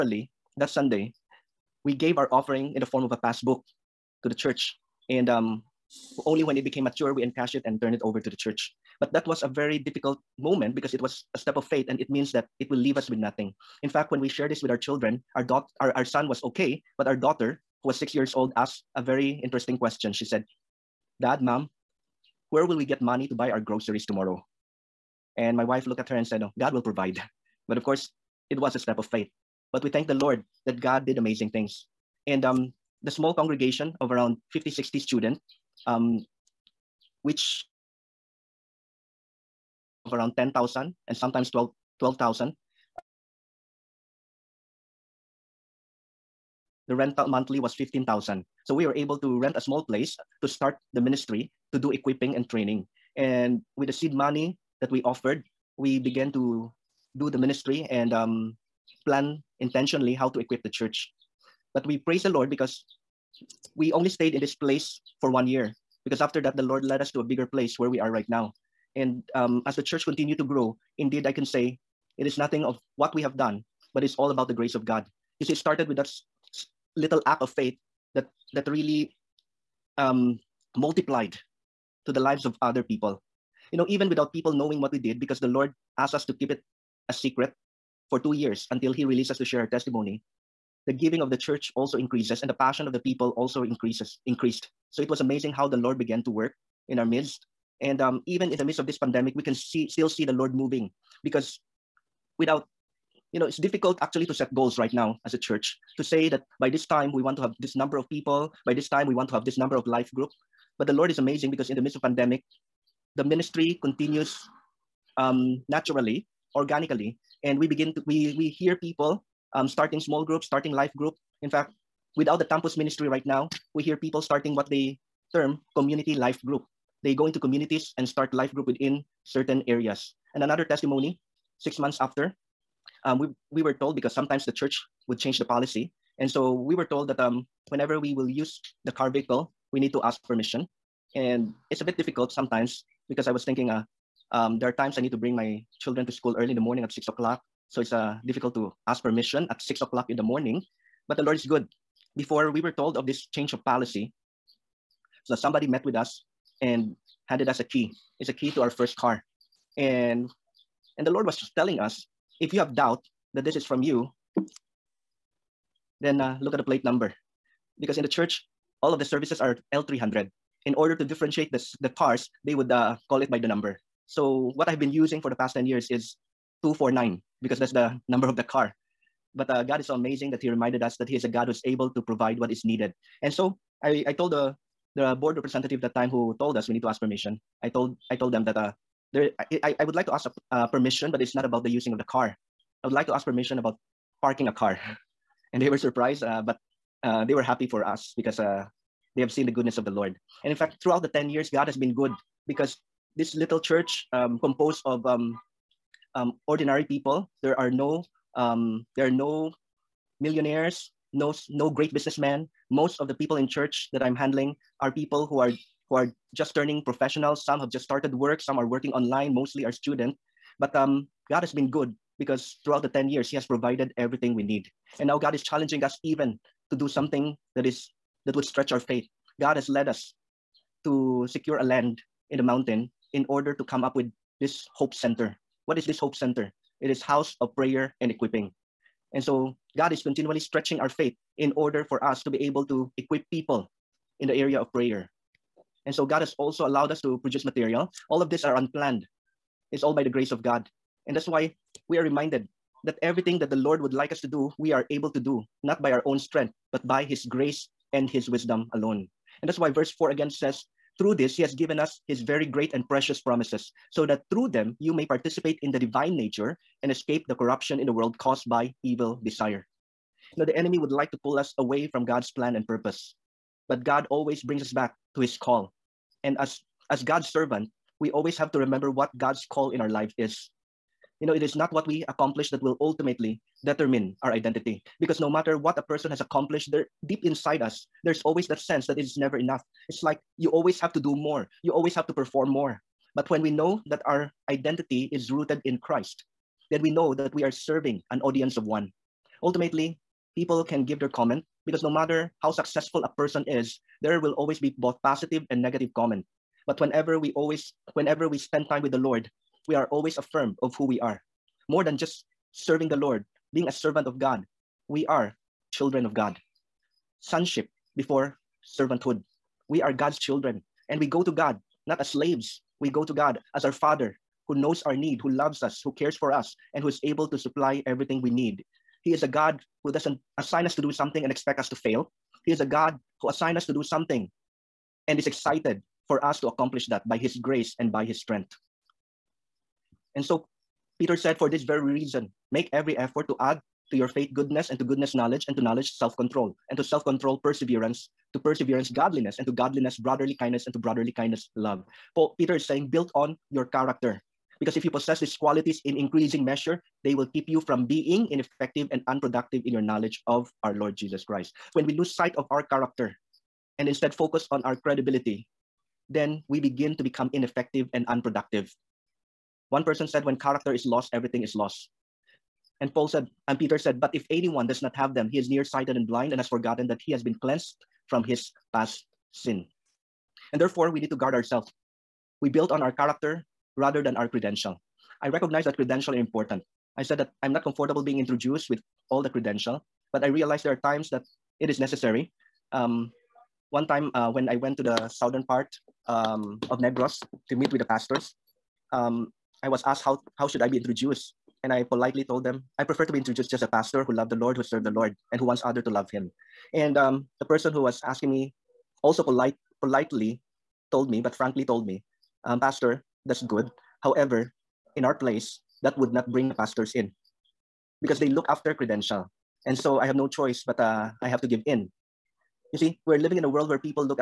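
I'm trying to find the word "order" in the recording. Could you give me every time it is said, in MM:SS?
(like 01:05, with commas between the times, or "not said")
02:50, 03:53, 04:01.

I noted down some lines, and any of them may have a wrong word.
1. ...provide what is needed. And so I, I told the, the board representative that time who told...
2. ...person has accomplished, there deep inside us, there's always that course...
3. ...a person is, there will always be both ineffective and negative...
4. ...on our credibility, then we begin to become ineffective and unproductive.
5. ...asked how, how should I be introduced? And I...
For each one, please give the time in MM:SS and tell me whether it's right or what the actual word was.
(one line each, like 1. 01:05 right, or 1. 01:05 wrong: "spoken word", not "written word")
1. 03:02 right
2. 04:45 wrong: "sense", not "course"
3. 05:03 wrong: "positive", not "ineffective"
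4. 06:04 right
5. 06:39 right.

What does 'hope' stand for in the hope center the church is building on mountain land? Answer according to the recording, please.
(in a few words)
house of prayer and equipping.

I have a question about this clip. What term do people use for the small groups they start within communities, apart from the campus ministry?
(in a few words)
community life group.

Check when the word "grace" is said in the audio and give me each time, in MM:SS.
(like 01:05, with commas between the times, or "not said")
01:14, 04:10, 04:17, 05:37.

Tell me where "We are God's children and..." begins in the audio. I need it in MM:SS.
05:19.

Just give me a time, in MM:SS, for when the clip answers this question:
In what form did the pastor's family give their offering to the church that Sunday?
00:03.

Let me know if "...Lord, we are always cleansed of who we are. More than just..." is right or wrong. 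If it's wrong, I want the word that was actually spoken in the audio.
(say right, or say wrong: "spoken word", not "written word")
wrong: "affirmed", not "cleansed".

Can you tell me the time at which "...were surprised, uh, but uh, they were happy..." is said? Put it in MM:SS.
03:15.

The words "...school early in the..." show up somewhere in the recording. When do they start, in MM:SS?
02:26.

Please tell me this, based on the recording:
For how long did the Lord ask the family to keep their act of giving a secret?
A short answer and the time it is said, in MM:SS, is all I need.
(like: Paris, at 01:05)
2 years, at 01:28.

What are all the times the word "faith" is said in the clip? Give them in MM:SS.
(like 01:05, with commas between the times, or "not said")
00:11, 00:29, 01:17, 03:48, 04:00, 05:44.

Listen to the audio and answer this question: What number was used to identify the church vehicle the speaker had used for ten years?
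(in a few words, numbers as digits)
249.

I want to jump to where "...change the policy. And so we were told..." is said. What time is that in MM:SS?
02:15.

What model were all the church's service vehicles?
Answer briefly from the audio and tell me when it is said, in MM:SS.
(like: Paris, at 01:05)
L300, at 02:49.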